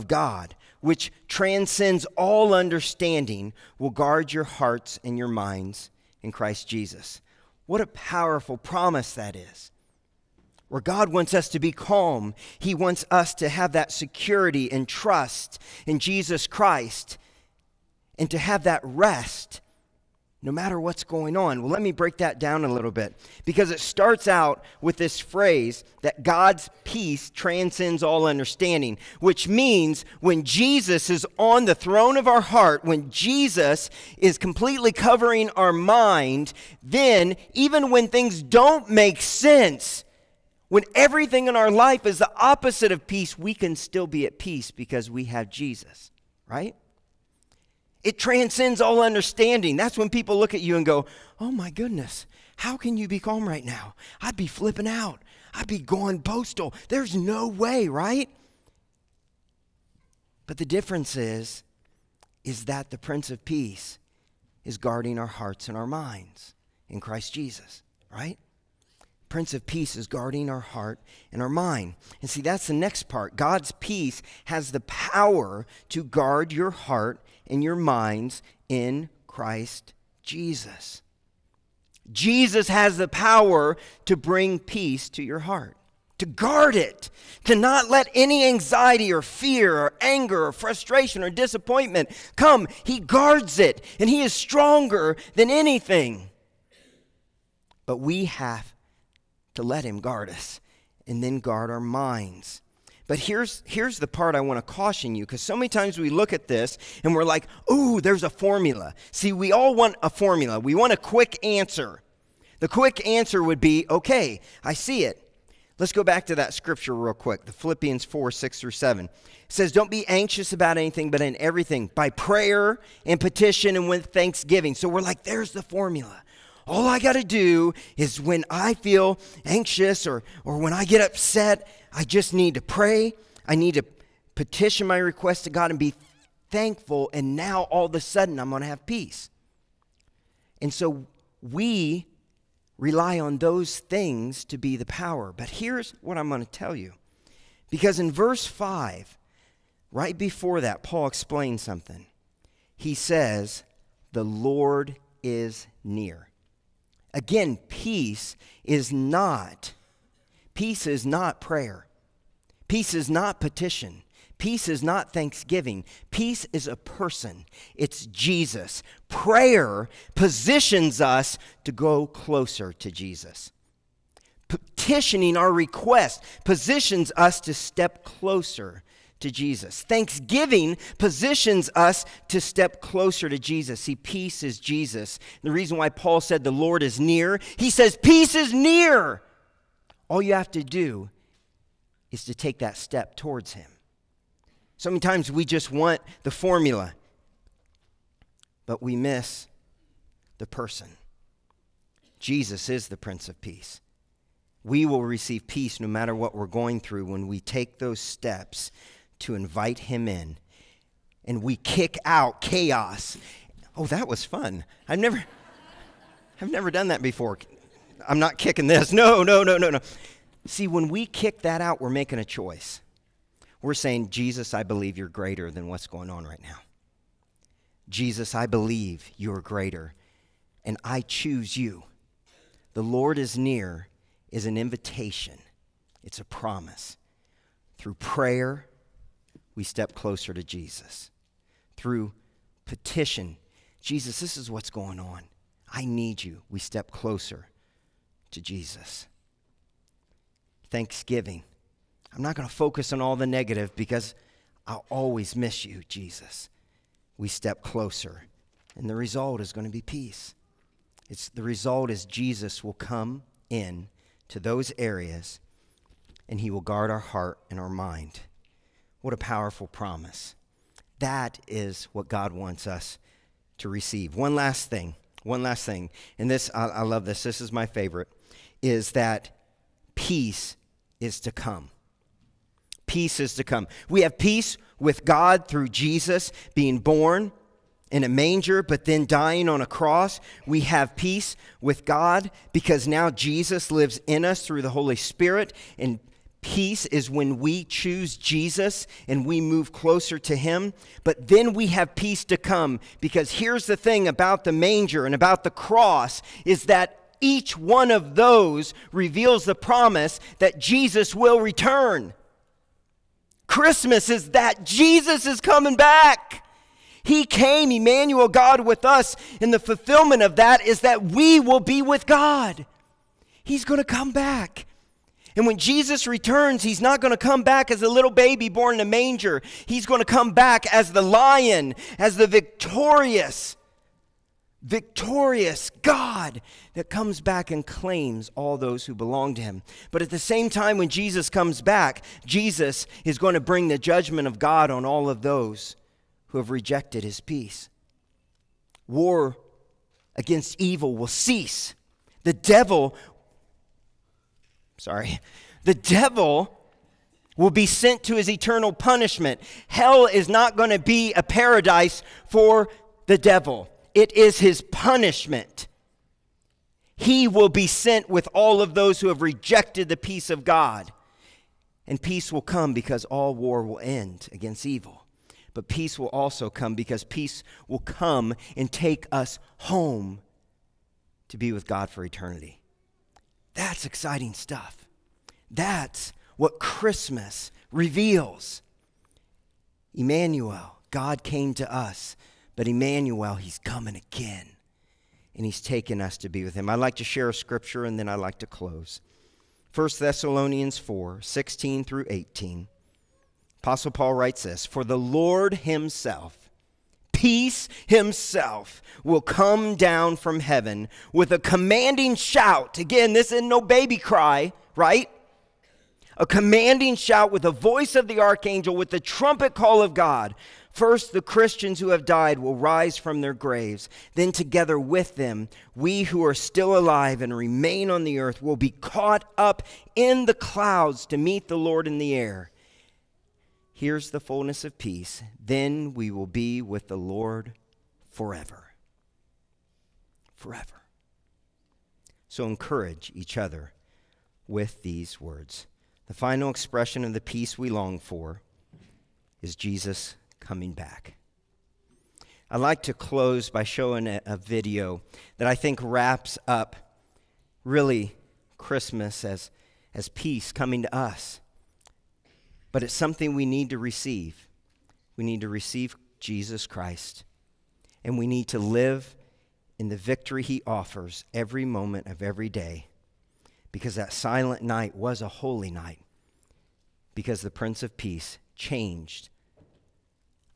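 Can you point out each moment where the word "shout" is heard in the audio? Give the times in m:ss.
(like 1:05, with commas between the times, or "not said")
6:52, 6:56.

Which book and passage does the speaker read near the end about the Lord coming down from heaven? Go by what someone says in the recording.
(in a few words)
1 Thessalonians 4:16-18.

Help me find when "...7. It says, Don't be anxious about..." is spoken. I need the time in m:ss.
1:58.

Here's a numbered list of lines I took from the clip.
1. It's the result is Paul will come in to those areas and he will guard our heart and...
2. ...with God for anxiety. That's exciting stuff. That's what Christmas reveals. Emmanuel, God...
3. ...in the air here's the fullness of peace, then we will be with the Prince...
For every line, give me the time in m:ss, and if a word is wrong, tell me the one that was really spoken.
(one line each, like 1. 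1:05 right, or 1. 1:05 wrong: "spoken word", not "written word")
1. 4:21 wrong: "Jesus", not "Paul"
2. 6:21 wrong: "eternity", not "anxiety"
3. 7:11 wrong: "Lord", not "Prince".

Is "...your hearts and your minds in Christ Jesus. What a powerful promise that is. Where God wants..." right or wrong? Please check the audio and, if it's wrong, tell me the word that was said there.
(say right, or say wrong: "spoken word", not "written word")
right.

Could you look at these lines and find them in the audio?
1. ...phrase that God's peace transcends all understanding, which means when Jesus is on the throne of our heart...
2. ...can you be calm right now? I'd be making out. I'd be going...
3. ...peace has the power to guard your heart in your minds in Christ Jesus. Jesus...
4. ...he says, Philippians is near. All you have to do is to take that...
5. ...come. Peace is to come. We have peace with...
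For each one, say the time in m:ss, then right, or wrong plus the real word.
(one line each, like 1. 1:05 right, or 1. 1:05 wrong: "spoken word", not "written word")
1. 0:25 right
2. 0:52 wrong: "flipping", not "making"
3. 1:13 right
4. 3:07 wrong: "Peace", not "Philippians"
5. 4:41 right.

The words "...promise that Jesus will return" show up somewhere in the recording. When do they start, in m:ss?
5:09.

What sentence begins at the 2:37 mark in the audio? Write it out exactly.
Again, peace is not peace is not prayer.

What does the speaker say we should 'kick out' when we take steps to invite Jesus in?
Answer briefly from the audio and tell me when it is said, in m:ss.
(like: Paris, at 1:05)
Chaos, at 3:32.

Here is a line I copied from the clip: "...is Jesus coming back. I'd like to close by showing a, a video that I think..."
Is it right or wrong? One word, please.
right.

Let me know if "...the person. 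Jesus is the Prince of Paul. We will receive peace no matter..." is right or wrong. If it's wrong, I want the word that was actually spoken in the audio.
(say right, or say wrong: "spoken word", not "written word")
wrong: "Peace", not "Paul".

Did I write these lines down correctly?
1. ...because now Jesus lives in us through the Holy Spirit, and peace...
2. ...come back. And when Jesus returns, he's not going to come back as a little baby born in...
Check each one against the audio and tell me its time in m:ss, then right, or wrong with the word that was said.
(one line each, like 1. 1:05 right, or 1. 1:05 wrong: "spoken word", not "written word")
1. 4:52 right
2. 5:23 right.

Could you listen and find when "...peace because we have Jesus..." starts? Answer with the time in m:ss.
0:44.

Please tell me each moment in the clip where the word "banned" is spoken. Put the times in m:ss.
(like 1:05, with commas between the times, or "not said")
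not said.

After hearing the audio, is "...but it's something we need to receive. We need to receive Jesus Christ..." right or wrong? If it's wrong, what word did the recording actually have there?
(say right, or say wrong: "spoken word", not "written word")
right.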